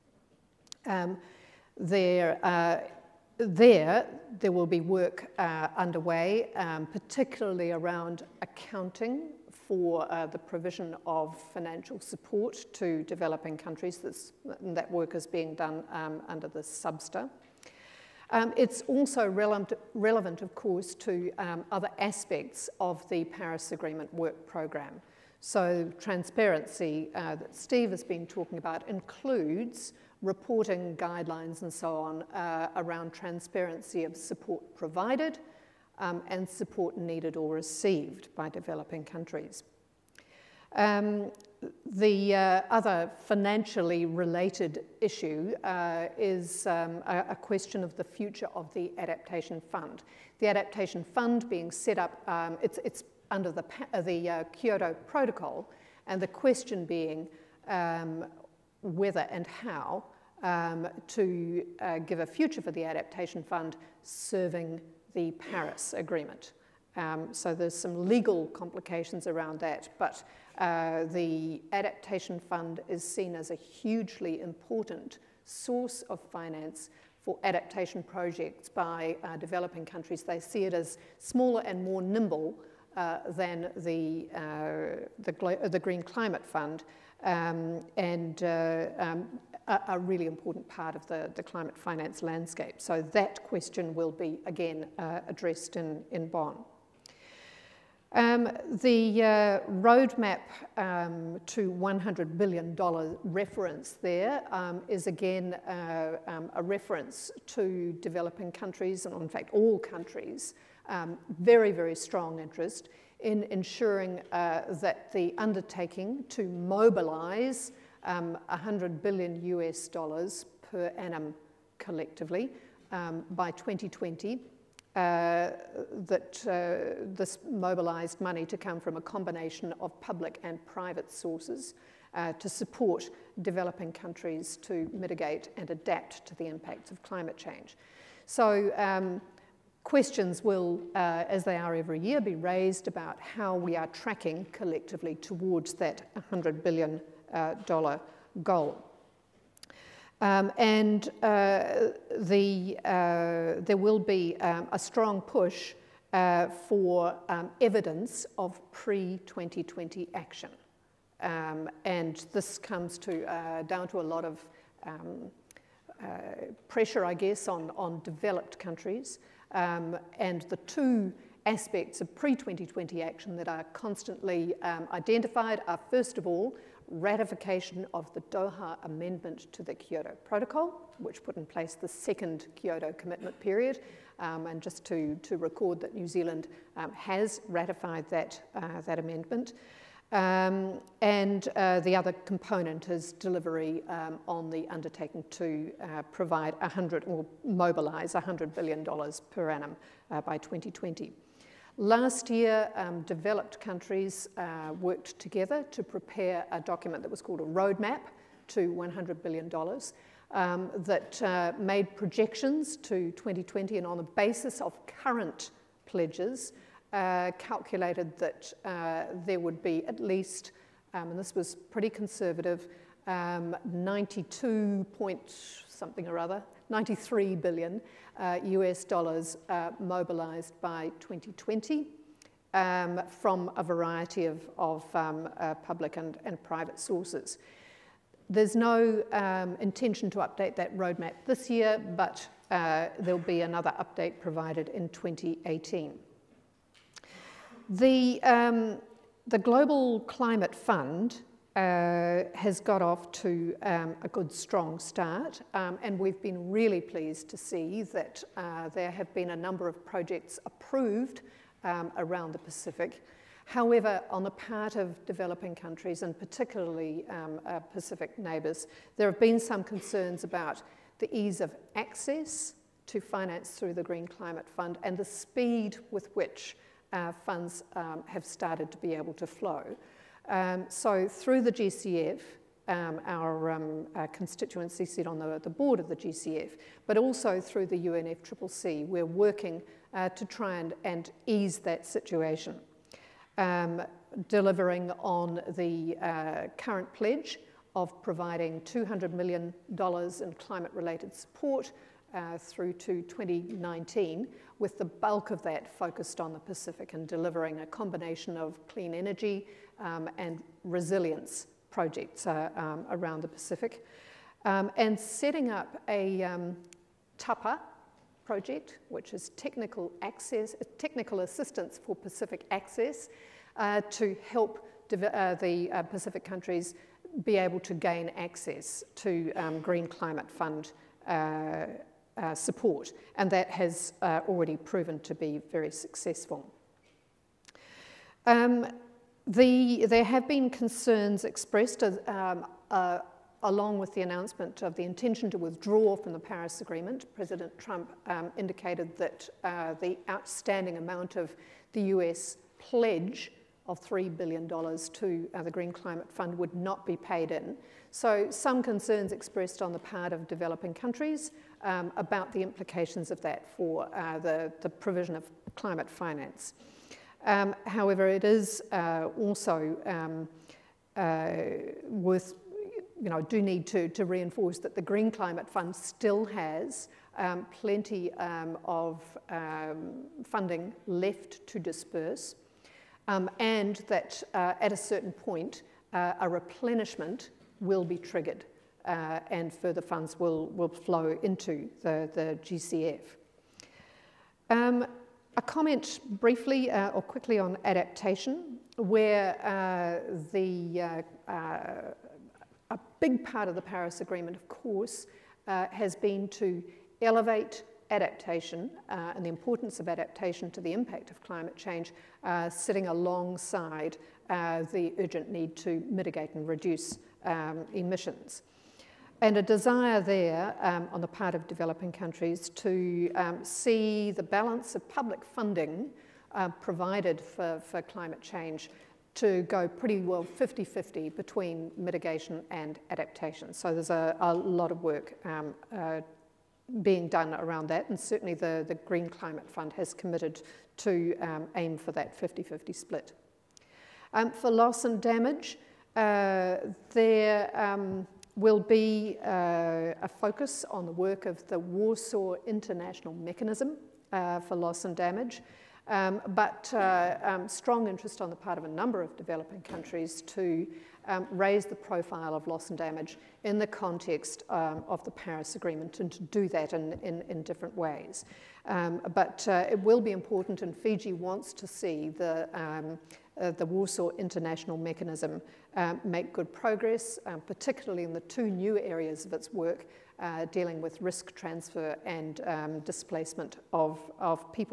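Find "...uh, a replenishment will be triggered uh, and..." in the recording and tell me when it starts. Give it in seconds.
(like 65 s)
385 s.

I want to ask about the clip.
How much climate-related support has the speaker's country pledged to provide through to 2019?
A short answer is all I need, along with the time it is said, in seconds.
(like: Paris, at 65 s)
$200 million, at 298 s.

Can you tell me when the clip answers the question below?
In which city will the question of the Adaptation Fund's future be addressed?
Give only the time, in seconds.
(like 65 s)
96 s.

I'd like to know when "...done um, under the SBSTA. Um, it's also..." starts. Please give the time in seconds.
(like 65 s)
15 s.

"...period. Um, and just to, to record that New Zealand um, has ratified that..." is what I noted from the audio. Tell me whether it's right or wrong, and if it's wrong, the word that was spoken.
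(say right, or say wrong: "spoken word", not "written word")
right.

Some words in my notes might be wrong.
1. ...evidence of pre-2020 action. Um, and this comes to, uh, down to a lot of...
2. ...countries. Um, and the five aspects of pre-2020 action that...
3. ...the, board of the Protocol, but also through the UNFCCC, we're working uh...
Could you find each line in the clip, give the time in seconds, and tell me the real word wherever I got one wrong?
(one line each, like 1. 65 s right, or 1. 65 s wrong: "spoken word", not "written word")
1. 157 s right
2. 168 s wrong: "two", not "five"
3. 285 s wrong: "GCF", not "Protocol".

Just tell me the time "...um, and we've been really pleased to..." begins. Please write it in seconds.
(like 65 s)
255 s.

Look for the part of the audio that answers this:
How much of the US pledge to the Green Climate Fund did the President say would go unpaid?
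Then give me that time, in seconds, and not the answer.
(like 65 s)
353 s.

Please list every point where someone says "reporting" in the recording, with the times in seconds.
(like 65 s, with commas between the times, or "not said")
30 s.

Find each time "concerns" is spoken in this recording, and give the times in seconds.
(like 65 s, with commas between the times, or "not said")
269 s, 340 s, 358 s.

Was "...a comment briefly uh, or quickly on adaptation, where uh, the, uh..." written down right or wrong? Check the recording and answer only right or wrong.
right.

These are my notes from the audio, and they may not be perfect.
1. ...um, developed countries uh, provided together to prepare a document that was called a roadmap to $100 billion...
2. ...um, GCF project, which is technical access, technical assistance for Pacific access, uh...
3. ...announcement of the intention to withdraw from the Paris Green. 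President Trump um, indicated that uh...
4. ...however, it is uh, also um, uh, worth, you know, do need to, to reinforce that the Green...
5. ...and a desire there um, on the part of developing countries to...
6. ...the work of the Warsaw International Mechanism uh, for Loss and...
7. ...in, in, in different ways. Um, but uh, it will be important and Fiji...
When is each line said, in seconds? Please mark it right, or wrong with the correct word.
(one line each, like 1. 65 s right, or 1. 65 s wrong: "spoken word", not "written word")
1. 202 s wrong: "worked", not "provided"
2. 316 s wrong: "TAPA", not "GCF"
3. 344 s wrong: "Agreement", not "Green"
4. 367 s right
5. 419 s right
6. 450 s right
7. 466 s right.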